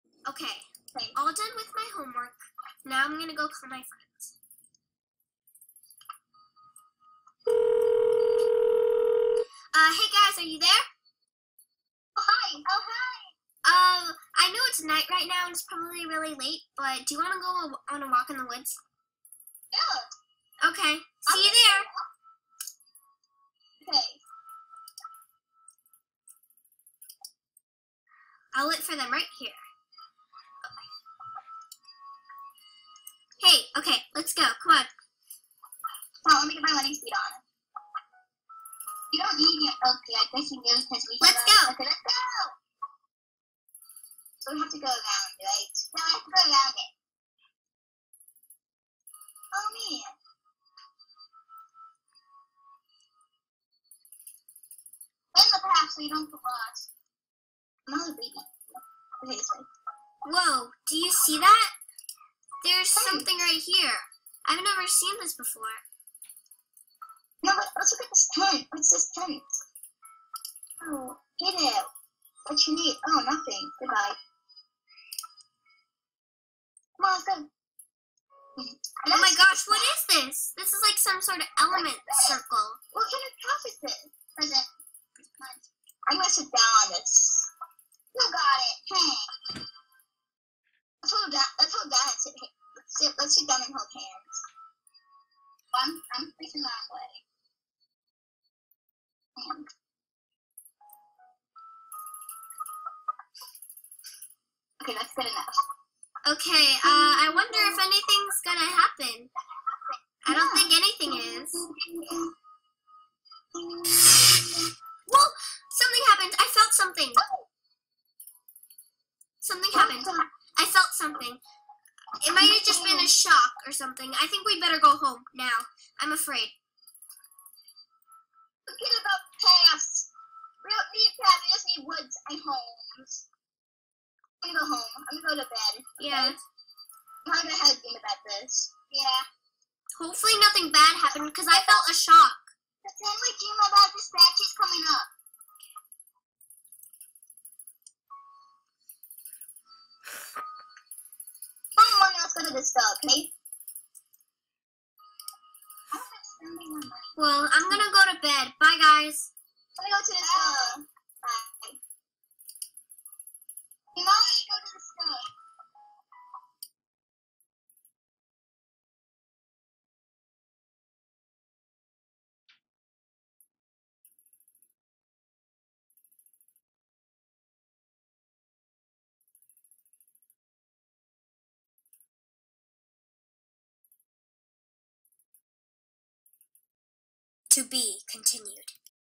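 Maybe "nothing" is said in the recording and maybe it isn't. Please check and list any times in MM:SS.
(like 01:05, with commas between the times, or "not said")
01:13, 02:20.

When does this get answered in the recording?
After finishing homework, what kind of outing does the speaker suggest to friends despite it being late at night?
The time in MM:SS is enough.
00:18.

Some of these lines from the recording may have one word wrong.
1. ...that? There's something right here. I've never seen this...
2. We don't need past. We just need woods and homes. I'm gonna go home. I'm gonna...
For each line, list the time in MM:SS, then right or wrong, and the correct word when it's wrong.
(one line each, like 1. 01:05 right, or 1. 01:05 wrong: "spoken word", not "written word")
1. 01:01 right
2. 02:10 right.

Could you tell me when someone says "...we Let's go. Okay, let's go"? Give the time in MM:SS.
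00:41.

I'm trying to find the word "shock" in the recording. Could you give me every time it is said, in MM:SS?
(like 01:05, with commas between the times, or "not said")
02:03, 02:21.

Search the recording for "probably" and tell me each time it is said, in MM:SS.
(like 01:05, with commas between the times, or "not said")
00:15.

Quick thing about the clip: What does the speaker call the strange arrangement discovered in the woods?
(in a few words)
Element circle.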